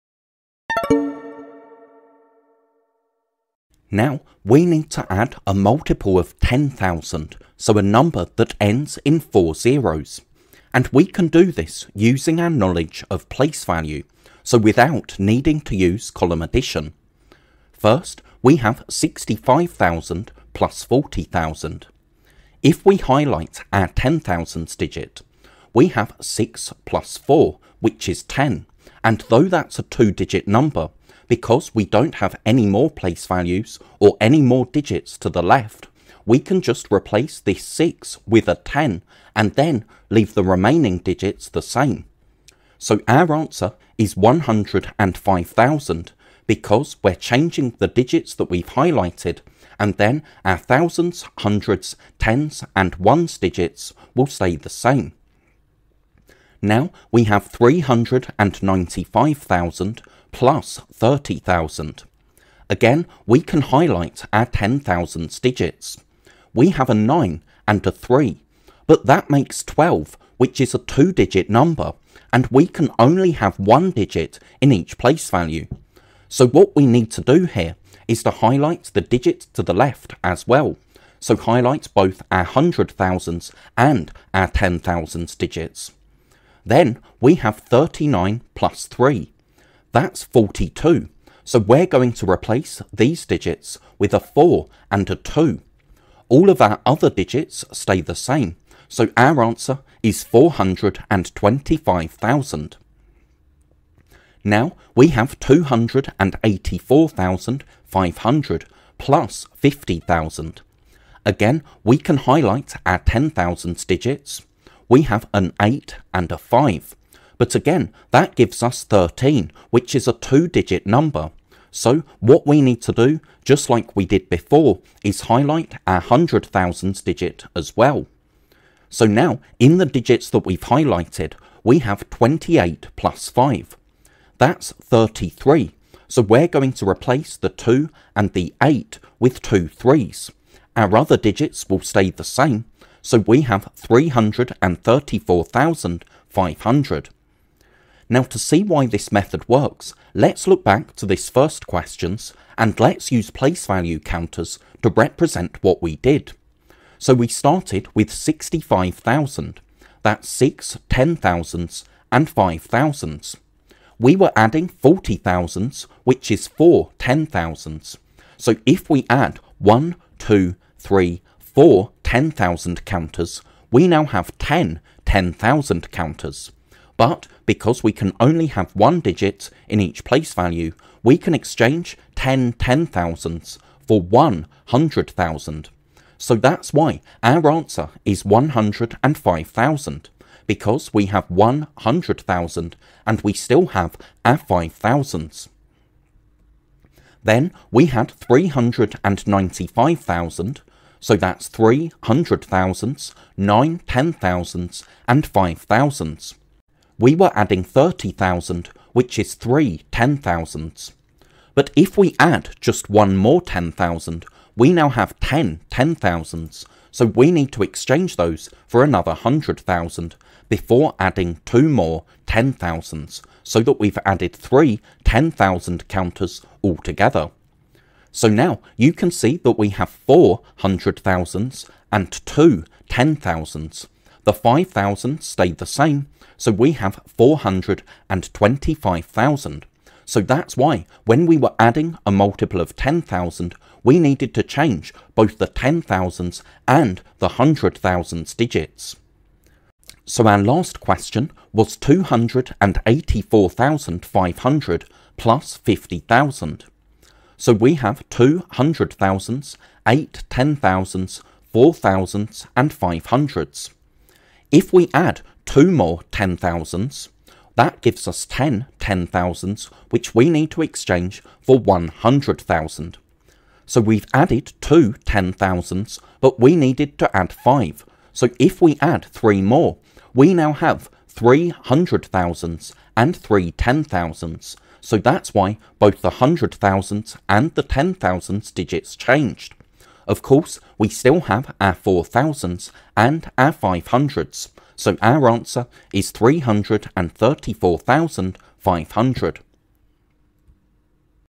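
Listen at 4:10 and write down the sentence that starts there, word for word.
So our last question was 284,500 plus 50,000.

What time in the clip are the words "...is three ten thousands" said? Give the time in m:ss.
3:29.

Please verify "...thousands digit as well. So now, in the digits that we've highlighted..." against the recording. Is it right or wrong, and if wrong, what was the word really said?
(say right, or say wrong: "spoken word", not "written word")
right.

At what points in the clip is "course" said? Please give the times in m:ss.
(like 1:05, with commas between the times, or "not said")
4:50.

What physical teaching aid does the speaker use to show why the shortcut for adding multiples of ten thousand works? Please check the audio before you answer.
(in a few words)
place value counters.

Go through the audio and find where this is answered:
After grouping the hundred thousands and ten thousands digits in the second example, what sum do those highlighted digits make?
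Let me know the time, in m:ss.
1:29.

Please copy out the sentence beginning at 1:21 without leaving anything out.
So highlight both our hundred and our ten digits.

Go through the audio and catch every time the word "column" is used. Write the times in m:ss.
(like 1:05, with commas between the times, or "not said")
0:16.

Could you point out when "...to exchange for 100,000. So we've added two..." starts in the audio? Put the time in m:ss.
4:30.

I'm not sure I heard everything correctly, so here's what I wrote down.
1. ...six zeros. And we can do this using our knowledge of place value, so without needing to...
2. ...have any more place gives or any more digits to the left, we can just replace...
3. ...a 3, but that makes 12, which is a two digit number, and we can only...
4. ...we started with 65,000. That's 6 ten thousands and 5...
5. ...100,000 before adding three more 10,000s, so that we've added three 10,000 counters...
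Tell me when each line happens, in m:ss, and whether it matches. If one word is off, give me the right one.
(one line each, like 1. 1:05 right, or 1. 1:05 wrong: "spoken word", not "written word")
1. 0:09 wrong: "four", not "six"
2. 0:32 wrong: "values", not "gives"
3. 1:07 right
4. 2:37 right
5. 3:39 wrong: "two", not "three".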